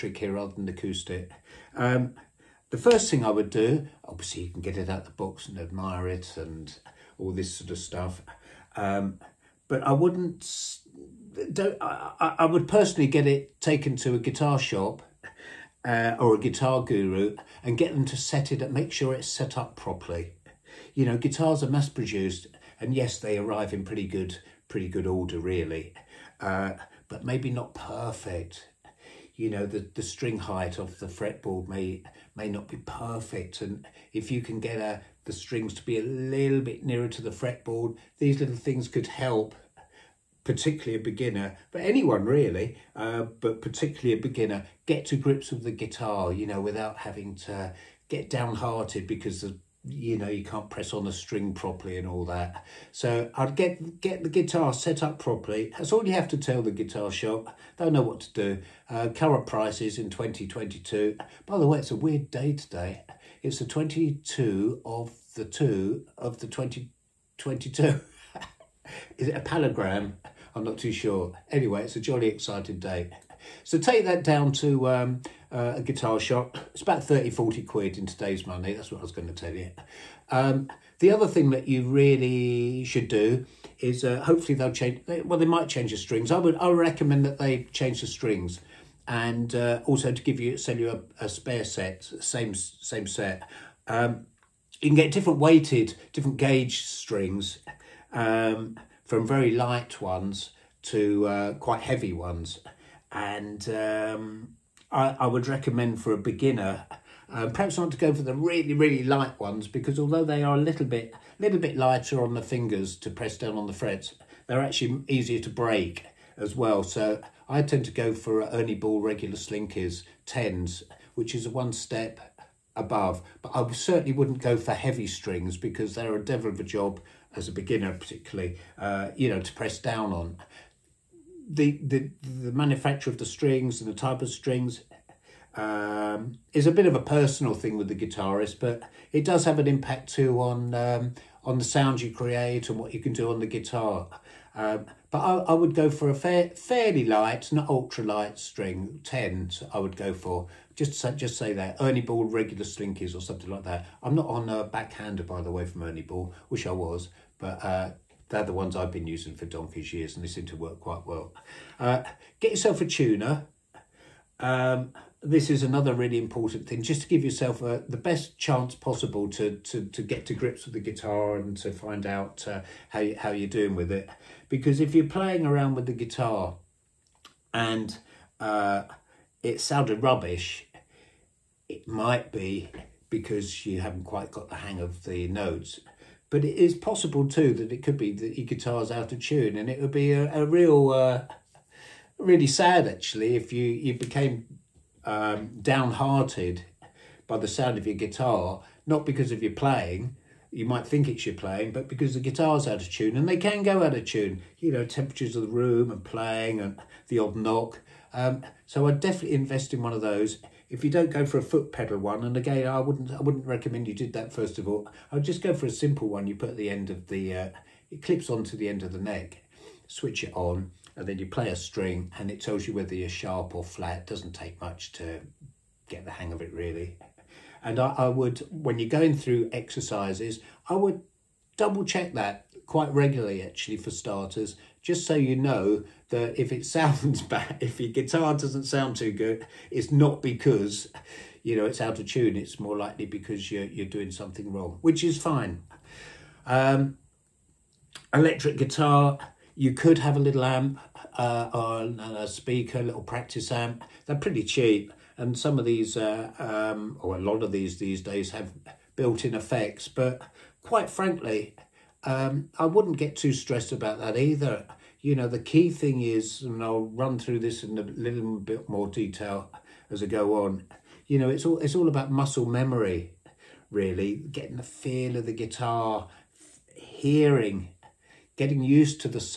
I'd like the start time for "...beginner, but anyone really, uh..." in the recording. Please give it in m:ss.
0:41.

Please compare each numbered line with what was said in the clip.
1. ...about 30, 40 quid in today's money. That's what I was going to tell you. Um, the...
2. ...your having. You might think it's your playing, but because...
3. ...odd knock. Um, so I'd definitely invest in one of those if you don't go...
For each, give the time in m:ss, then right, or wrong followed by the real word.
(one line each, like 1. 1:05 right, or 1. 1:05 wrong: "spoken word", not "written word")
1. 1:16 right
2. 3:19 wrong: "playing", not "having"
3. 3:27 right.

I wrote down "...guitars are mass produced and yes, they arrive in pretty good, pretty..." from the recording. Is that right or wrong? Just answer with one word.
right.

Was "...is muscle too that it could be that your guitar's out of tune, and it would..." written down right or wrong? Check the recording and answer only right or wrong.
wrong.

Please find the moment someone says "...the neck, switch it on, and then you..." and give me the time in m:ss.
3:38.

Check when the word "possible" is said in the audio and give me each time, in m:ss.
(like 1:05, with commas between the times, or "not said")
2:48, 3:06.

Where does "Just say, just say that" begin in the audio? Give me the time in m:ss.
2:30.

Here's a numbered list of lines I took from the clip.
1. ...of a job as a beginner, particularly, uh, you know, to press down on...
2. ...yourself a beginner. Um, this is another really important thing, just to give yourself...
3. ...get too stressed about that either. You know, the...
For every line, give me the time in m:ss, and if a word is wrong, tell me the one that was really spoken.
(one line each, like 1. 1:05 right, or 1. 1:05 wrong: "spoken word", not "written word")
1. 2:06 right
2. 2:42 wrong: "tuner", not "beginner"
3. 4:22 right.